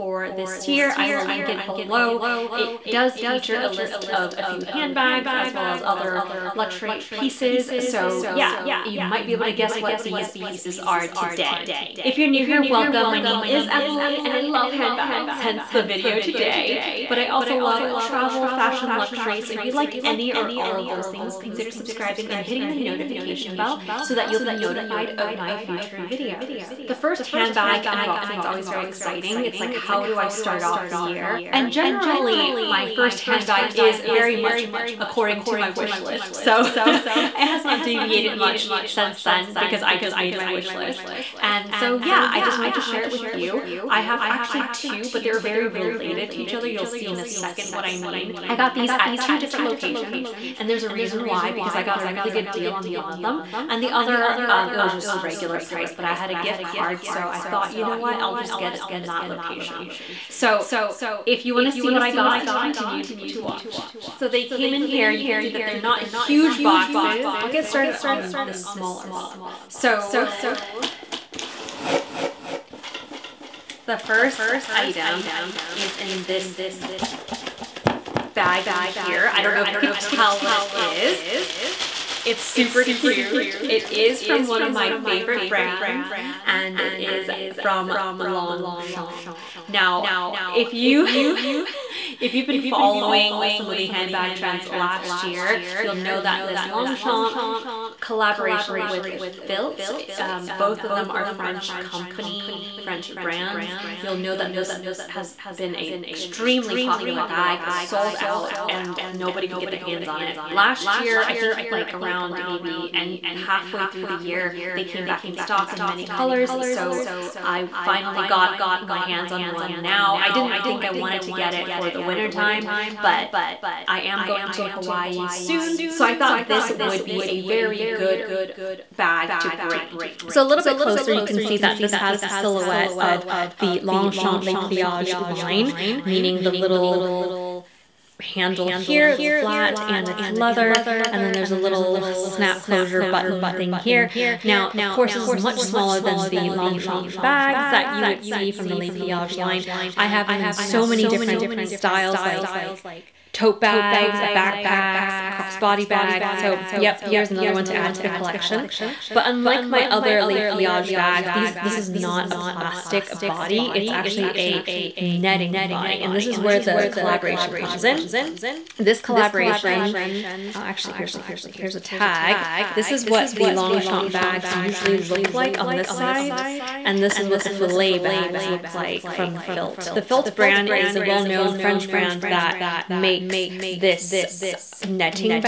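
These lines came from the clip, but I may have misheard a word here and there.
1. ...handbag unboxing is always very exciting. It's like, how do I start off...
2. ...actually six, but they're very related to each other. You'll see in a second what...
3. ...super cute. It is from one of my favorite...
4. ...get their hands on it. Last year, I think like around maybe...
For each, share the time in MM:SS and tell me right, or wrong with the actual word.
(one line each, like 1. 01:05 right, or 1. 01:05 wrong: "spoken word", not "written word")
1. 00:27 right
2. 00:44 wrong: "two", not "six"
3. 01:22 right
4. 01:49 right.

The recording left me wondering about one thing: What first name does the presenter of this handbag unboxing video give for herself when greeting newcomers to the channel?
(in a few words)
Emily.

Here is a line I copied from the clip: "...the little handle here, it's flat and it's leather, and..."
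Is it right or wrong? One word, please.
right.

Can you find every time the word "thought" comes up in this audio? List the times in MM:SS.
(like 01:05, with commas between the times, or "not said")
00:57, 02:06.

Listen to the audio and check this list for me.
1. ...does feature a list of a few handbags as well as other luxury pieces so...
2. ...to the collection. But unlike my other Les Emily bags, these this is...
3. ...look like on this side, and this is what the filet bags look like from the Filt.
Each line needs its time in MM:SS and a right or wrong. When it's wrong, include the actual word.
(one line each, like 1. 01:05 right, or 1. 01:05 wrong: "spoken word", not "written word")
1. 00:02 right
2. 02:37 wrong: "Pliage", not "Emily"
3. 02:54 right.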